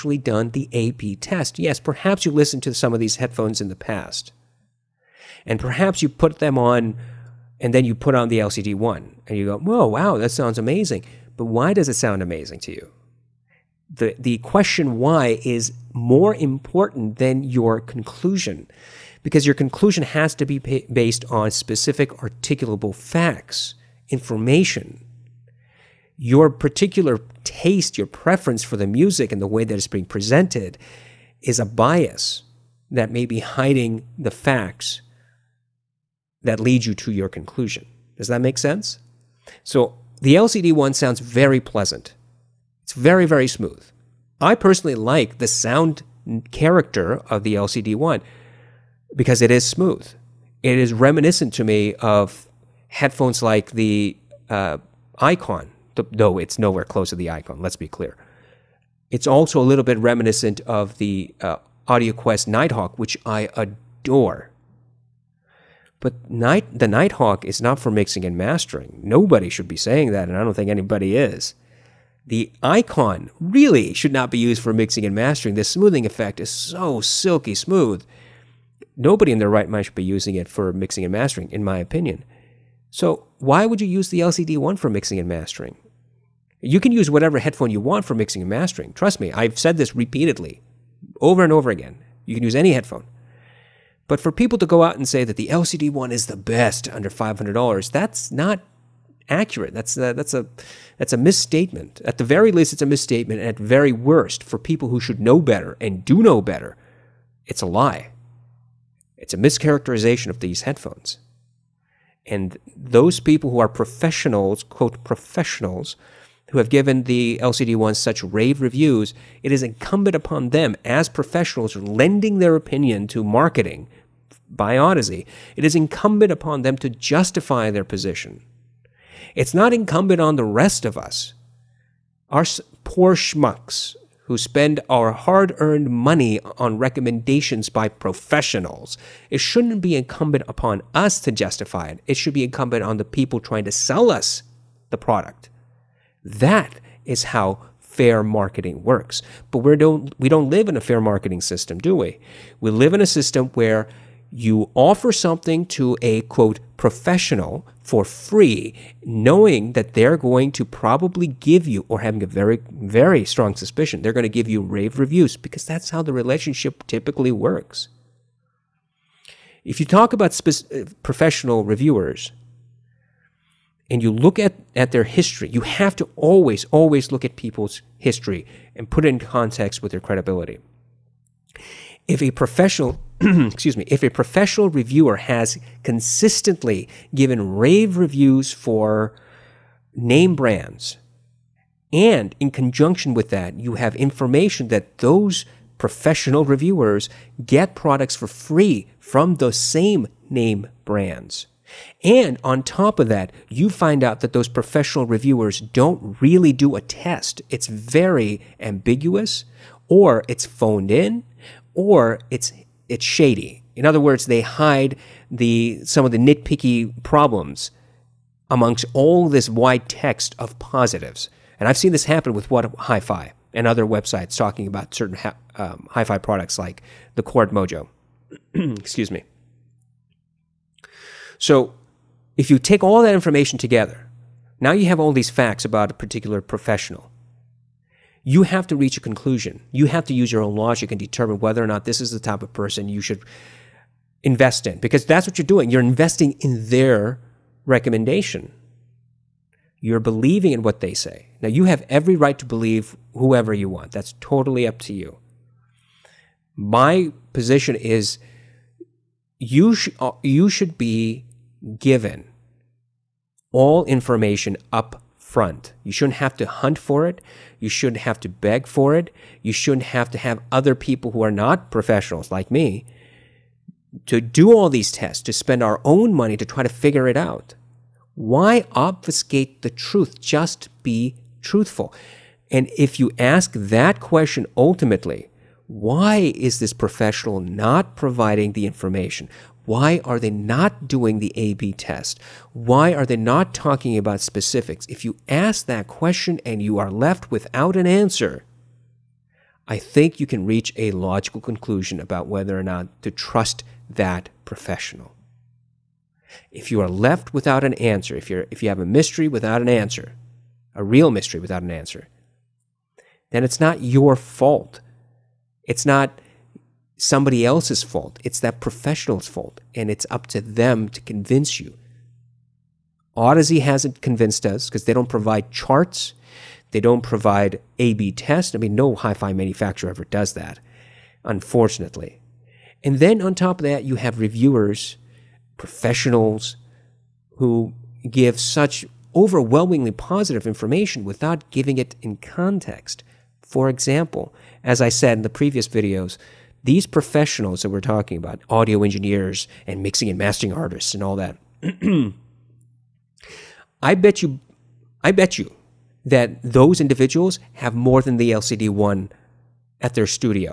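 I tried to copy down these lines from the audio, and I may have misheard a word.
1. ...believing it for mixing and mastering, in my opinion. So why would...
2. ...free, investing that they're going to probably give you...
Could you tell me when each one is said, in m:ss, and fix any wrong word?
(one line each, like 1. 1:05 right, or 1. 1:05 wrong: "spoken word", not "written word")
1. 1:20 wrong: "using", not "believing"
2. 2:38 wrong: "knowing", not "investing".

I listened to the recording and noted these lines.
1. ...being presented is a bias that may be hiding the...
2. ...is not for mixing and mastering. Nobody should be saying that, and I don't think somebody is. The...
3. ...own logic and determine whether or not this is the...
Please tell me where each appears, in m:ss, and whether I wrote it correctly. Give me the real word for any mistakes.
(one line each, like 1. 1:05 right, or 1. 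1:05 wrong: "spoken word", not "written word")
1. 0:29 right
2. 1:07 wrong: "anybody", not "somebody"
3. 4:00 right.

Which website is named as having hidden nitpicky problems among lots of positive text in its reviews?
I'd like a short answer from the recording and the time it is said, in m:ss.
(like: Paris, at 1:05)
What Hi-Fi, at 3:42.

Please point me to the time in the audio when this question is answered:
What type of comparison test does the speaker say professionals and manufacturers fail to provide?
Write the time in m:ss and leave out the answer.
4:51.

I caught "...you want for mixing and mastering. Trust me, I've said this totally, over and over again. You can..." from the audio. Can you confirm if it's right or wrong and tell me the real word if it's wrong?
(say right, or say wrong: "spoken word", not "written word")
wrong: "repeatedly", not "totally".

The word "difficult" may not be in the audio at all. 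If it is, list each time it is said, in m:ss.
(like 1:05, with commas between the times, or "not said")
not said.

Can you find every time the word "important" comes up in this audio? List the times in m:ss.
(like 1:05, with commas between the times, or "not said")
0:16.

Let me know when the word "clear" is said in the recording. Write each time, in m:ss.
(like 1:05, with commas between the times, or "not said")
0:57.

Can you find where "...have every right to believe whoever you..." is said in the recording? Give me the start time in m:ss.
4:11.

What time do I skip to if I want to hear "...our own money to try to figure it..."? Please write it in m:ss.
4:35.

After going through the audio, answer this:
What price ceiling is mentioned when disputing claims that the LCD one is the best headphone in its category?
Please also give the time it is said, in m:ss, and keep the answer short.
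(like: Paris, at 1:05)
$500, at 1:37.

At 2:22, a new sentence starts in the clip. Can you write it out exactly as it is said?
It should be incumbent on the people trying to sell us the product.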